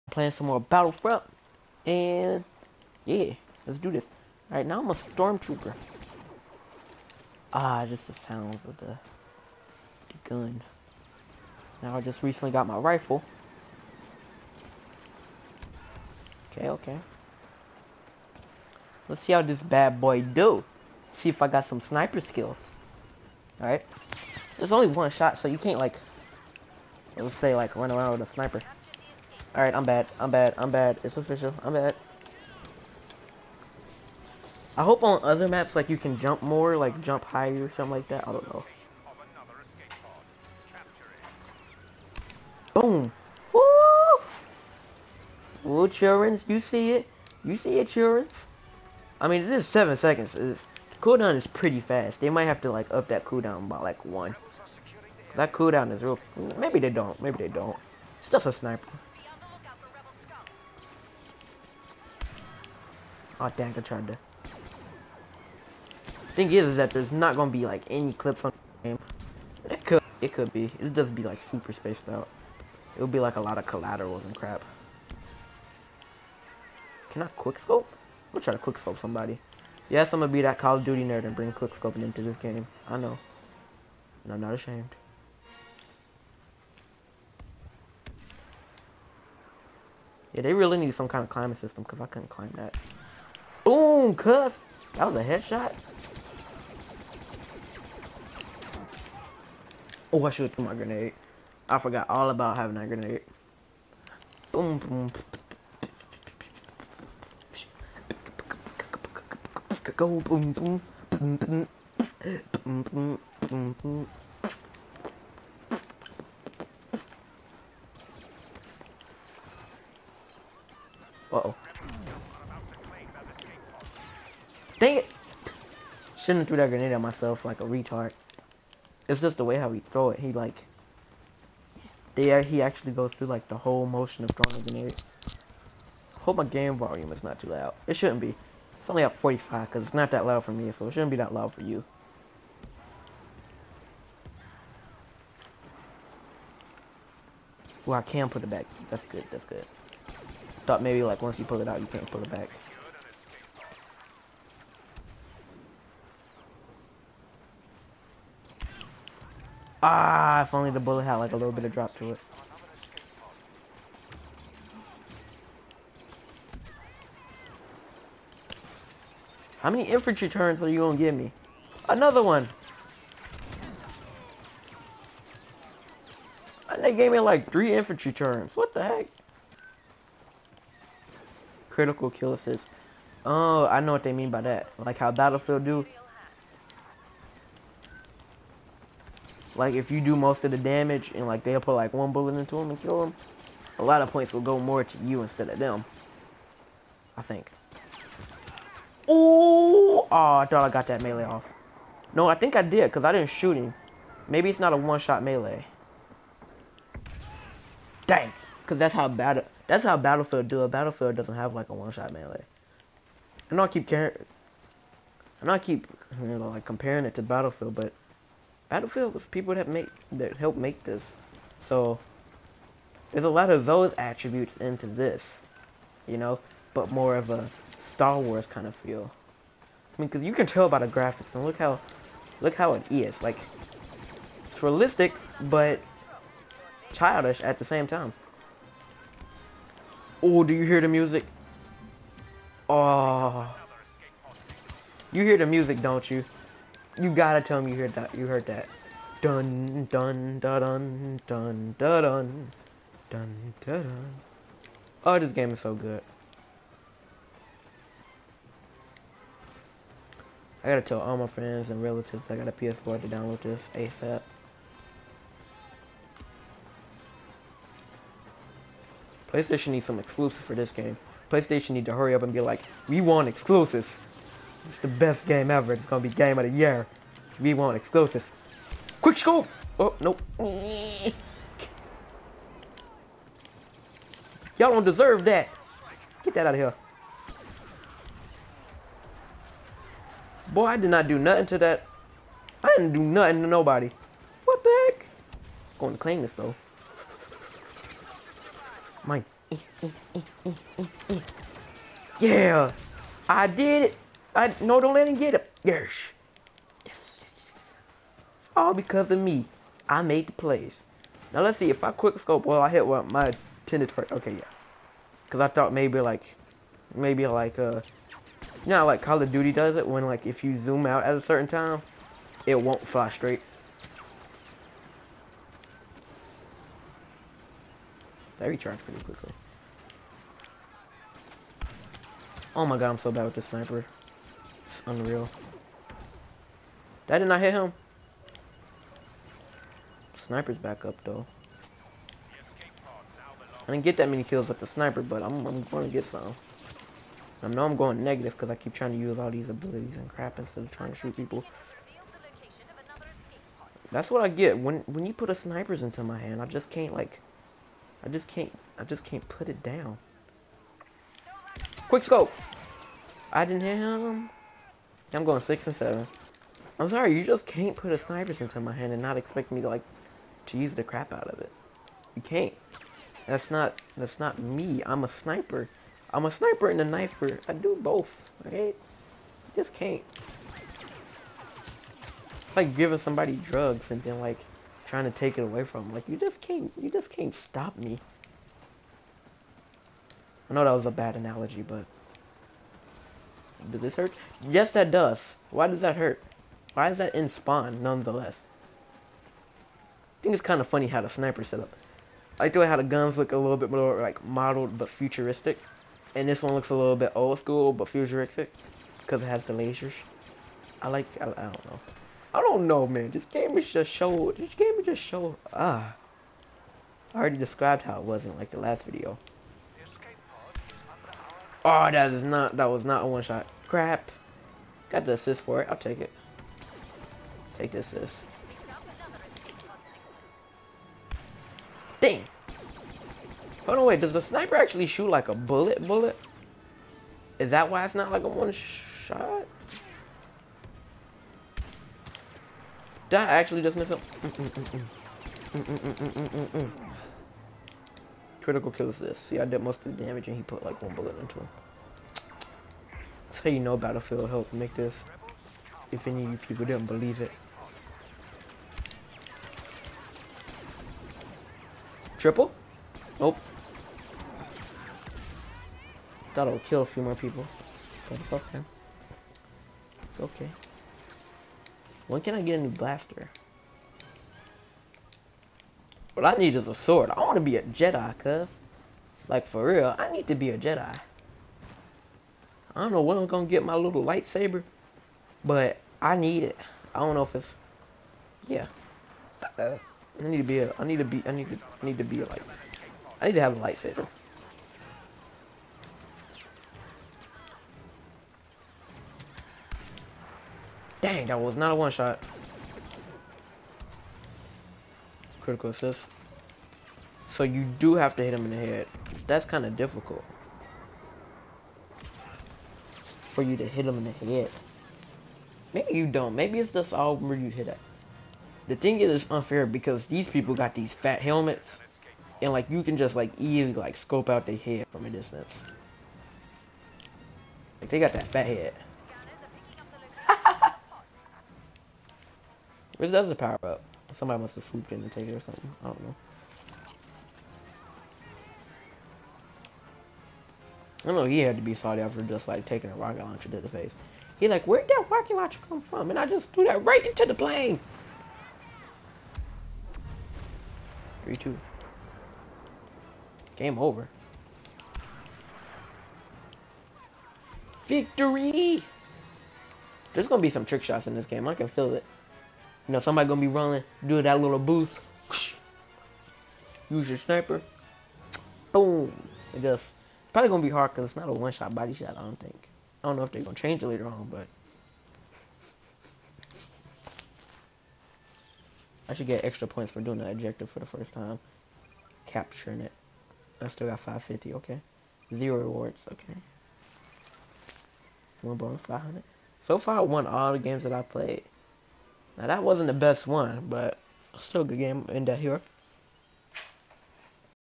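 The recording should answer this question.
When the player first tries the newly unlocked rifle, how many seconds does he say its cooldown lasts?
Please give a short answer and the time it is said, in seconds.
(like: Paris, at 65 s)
7, at 49 s.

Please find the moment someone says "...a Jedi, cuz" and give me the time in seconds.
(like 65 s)
477 s.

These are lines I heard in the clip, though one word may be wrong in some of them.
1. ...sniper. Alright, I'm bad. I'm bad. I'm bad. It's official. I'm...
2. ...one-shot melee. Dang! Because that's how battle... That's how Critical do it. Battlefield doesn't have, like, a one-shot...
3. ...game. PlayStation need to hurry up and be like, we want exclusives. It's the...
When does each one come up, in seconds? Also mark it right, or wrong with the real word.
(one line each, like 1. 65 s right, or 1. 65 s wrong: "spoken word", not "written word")
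1. 28 s right
2. 204 s wrong: "Battlefield", not "Critical"
3. 270 s right.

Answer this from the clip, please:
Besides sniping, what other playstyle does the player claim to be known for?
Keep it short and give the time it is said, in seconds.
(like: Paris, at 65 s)
knifer, at 376 s.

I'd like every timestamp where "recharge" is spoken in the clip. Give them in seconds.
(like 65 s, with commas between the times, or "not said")
328 s.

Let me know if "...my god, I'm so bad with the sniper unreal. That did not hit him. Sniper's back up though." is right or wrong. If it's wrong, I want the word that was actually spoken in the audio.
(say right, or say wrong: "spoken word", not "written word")
right.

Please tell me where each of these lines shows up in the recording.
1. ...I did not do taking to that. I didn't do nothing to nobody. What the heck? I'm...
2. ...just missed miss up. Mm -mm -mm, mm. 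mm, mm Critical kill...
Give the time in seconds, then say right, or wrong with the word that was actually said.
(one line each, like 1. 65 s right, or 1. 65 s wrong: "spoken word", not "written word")
1. 290 s wrong: "nothing", not "taking"
2. 443 s right.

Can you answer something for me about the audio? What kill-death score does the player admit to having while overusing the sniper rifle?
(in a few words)
6 and 7.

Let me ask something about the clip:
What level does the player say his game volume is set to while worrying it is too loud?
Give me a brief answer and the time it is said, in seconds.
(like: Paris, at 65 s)
45, at 139 s.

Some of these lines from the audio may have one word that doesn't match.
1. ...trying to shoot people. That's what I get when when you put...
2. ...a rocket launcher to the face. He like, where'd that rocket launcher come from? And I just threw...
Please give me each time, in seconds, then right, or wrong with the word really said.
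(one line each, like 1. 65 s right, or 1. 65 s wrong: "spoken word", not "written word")
1. 350 s right
2. 542 s right.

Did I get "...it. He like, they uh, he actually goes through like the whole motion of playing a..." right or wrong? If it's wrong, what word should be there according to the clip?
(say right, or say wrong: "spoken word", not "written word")
wrong: "throwing", not "playing".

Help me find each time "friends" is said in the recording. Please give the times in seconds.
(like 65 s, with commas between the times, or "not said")
261 s.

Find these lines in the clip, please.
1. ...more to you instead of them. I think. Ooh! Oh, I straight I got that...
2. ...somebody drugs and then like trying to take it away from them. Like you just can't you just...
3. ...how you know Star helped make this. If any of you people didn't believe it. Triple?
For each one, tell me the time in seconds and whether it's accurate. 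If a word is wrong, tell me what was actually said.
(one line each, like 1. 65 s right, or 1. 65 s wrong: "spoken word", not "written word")
1. 194 s wrong: "thought", not "straight"
2. 382 s right
3. 453 s wrong: "Battlefield", not "Star".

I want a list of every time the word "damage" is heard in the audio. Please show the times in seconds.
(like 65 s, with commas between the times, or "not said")
190 s, 450 s.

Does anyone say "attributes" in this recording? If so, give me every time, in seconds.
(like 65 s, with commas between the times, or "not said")
223 s.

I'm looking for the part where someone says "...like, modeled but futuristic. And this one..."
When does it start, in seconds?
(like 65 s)
404 s.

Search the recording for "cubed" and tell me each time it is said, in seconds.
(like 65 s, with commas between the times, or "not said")
not said.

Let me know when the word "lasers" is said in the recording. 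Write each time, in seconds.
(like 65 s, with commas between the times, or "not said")
409 s.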